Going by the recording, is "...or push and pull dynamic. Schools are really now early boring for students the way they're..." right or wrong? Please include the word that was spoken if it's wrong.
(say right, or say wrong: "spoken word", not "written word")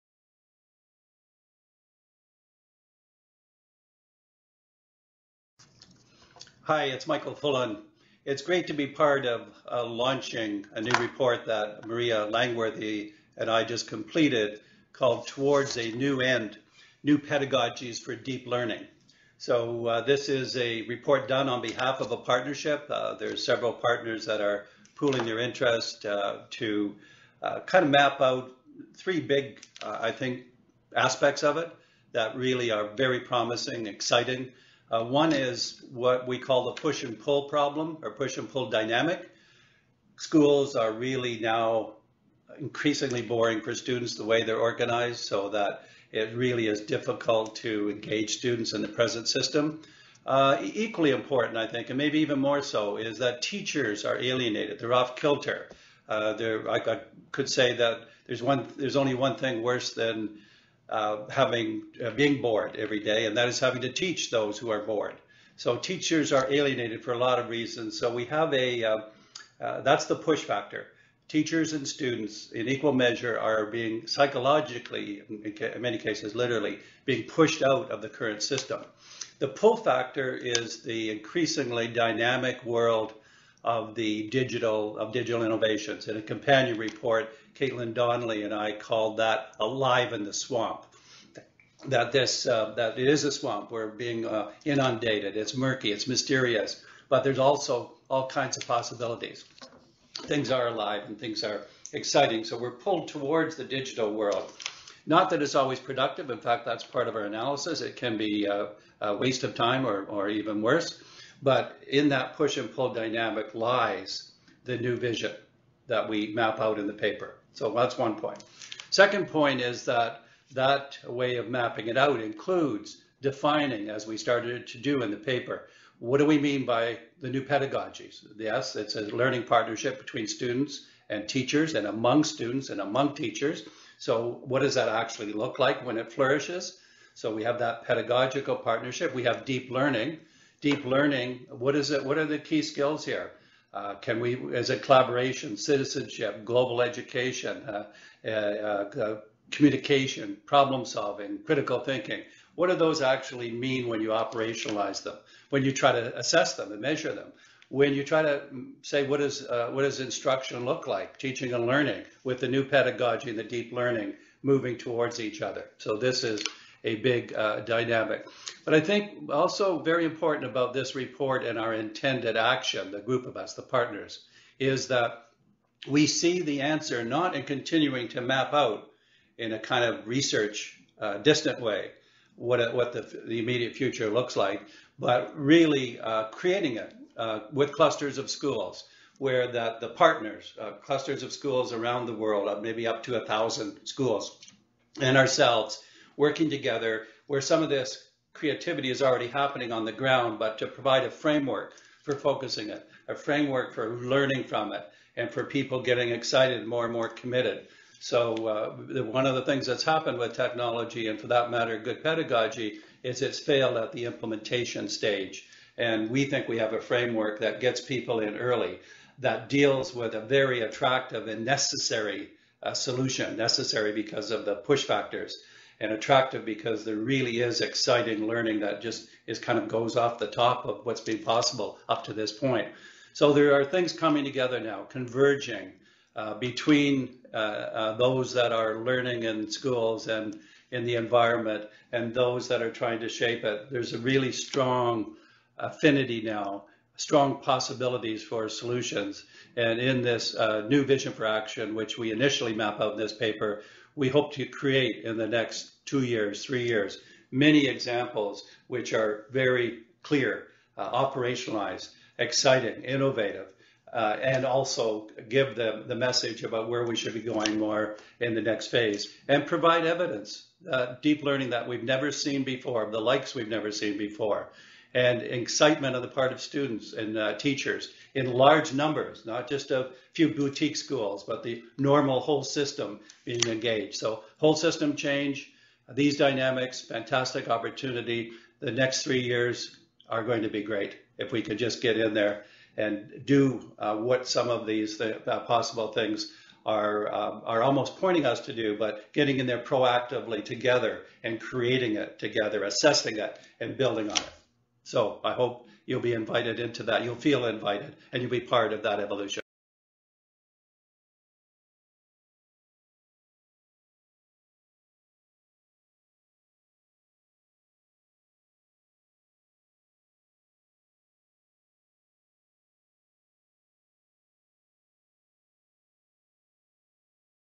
wrong: "increasingly", not "early".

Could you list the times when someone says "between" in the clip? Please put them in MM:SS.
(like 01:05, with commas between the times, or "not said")
02:09, 03:56.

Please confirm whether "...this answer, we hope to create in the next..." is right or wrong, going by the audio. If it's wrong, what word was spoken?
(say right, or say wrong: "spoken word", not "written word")
wrong: "paper", not "answer".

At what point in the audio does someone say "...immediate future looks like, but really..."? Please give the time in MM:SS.
03:03.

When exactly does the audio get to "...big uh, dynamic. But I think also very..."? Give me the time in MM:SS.
02:46.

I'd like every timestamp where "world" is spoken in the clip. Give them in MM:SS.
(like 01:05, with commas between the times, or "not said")
01:22, 01:44, 03:12.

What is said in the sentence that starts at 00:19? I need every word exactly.
So uh, this is a report done on behalf of a partnership.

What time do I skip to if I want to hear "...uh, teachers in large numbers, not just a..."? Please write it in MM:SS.
04:37.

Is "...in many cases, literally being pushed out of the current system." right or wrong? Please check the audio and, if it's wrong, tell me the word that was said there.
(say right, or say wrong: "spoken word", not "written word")
right.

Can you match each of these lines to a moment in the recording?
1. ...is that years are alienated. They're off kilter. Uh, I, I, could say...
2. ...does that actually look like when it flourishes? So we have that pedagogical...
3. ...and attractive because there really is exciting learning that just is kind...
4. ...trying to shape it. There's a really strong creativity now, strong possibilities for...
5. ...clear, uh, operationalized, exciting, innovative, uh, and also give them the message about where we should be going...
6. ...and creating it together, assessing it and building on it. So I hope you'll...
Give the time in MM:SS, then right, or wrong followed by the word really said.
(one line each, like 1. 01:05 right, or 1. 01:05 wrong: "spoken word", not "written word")
1. 00:52 wrong: "teachers", not "years"
2. 02:14 right
3. 03:45 right
4. 04:02 wrong: "affinity", not "creativity"
5. 04:20 right
6. 05:01 right.